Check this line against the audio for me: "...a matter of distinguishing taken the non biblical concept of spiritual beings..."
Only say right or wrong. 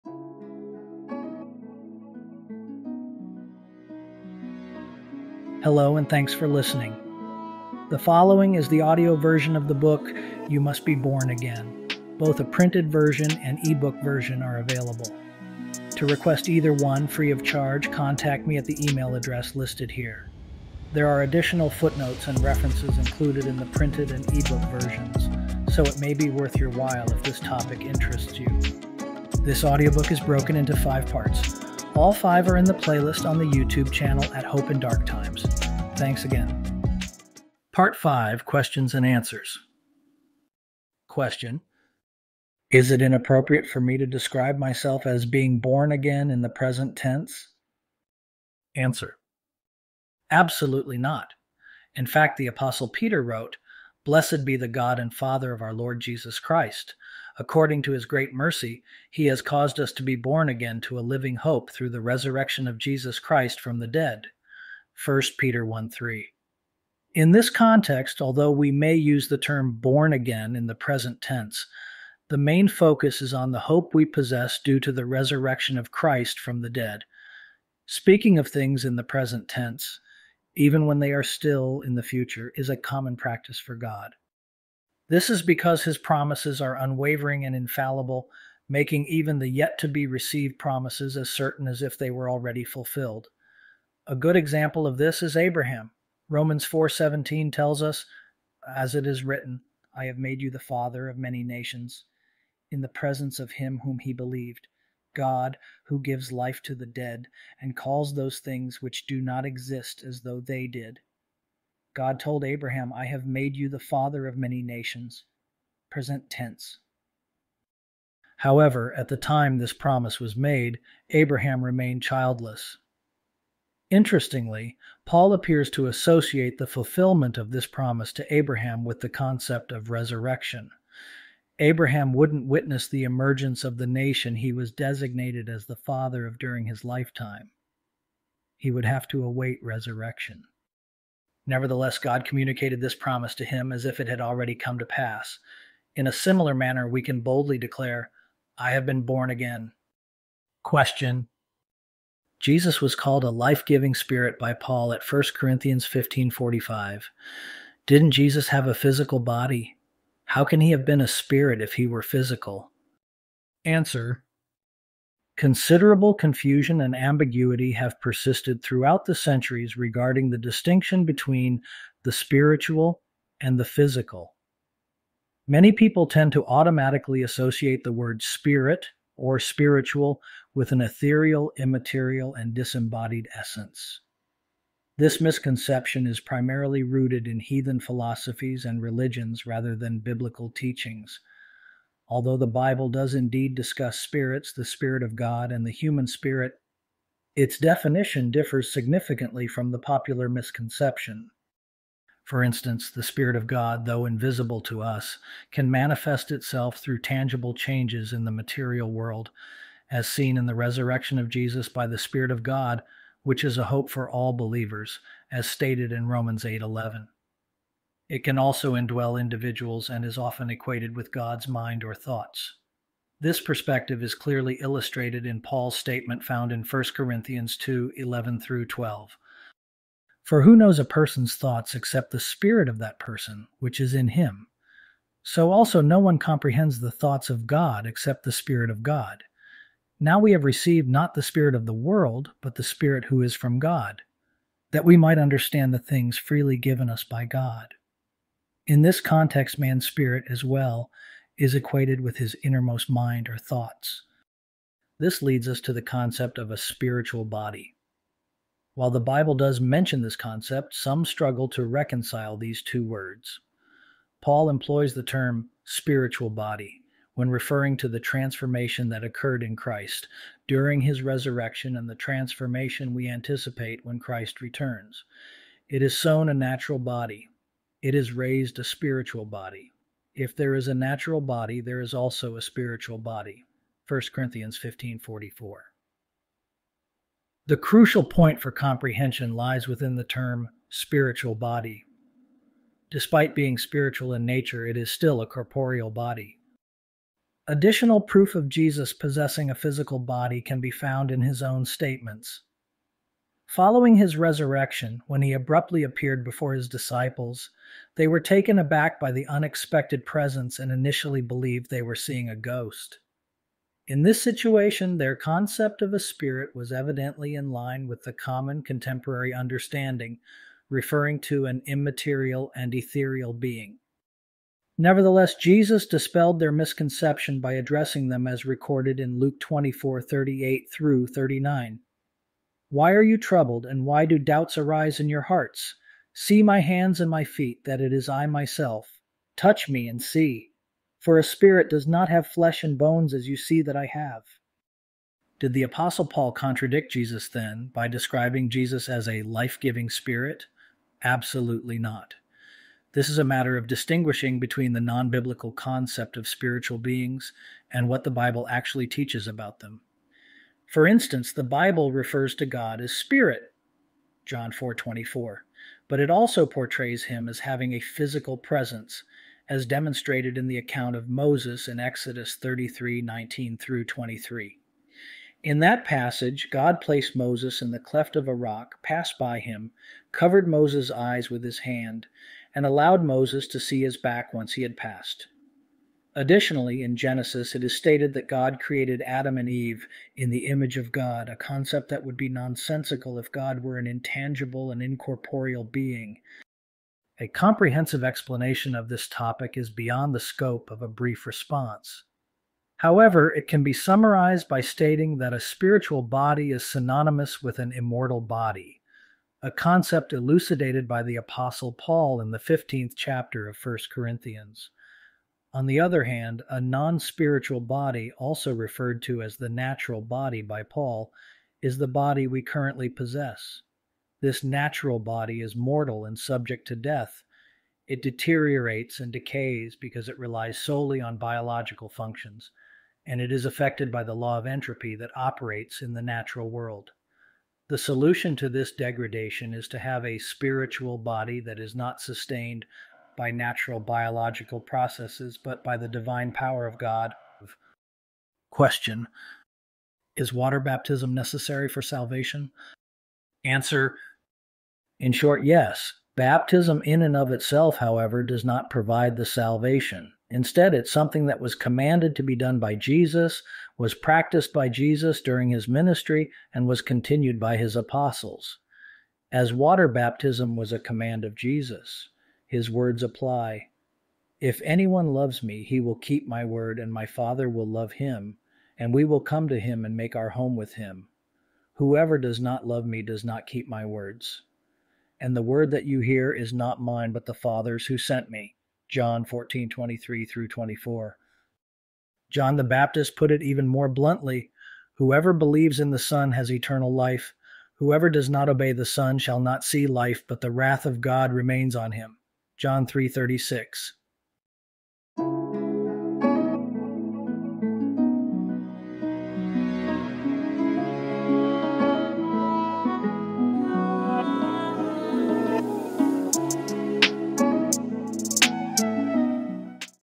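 wrong.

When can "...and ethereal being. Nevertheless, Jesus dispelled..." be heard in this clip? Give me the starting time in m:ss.
5:22.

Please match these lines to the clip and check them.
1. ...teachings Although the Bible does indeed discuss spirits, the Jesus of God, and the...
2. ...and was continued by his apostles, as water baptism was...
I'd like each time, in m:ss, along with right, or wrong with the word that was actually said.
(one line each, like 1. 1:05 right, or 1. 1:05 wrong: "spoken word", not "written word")
1. 3:10 wrong: "Spirit", not "Jesus"
2. 7:46 right.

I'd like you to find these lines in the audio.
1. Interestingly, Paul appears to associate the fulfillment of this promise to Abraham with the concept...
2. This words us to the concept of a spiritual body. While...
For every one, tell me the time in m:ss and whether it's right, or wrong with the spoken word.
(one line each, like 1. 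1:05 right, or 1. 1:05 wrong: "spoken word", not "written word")
1. 2:03 right
2. 4:14 wrong: "leads", not "words".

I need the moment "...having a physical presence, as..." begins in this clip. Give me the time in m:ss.
6:07.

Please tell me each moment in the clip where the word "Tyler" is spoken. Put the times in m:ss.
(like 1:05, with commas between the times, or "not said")
not said.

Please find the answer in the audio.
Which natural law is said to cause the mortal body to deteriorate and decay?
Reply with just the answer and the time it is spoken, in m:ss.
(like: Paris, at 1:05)
the law of entropy, at 7:14.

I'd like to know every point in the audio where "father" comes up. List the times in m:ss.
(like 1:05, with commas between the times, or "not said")
0:55, 1:40, 1:53, 2:15, 7:57, 8:07.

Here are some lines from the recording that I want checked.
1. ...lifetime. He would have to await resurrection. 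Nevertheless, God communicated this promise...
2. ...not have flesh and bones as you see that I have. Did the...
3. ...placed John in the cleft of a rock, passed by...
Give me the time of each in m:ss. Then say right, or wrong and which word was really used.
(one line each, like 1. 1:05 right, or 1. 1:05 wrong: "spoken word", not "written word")
1. 2:16 right
2. 5:41 right
3. 6:16 wrong: "Moses", not "John".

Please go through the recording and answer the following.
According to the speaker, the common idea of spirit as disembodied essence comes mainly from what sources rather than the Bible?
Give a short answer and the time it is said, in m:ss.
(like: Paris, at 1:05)
heathen philosophies and religions, at 3:07.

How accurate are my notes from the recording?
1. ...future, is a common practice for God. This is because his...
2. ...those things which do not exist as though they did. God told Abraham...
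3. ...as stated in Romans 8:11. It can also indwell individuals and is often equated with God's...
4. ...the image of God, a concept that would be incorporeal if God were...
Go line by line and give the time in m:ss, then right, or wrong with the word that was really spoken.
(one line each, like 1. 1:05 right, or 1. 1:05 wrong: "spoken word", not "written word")
1. 1:22 right
2. 1:48 right
3. 3:35 right
4. 6:30 wrong: "nonsensical", not "incorporeal".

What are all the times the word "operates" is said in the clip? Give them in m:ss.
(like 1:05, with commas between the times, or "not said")
7:15.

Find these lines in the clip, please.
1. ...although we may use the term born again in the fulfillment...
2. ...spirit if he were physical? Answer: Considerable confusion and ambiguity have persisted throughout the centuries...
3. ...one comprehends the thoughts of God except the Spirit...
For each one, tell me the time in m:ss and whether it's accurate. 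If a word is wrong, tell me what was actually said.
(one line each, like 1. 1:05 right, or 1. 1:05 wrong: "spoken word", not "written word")
1. 1:08 wrong: "present", not "fulfillment"
2. 2:41 right
3. 3:55 right.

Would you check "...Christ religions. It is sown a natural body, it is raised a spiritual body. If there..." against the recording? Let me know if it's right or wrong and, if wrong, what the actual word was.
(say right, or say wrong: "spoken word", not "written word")
wrong: "returns", not "religions".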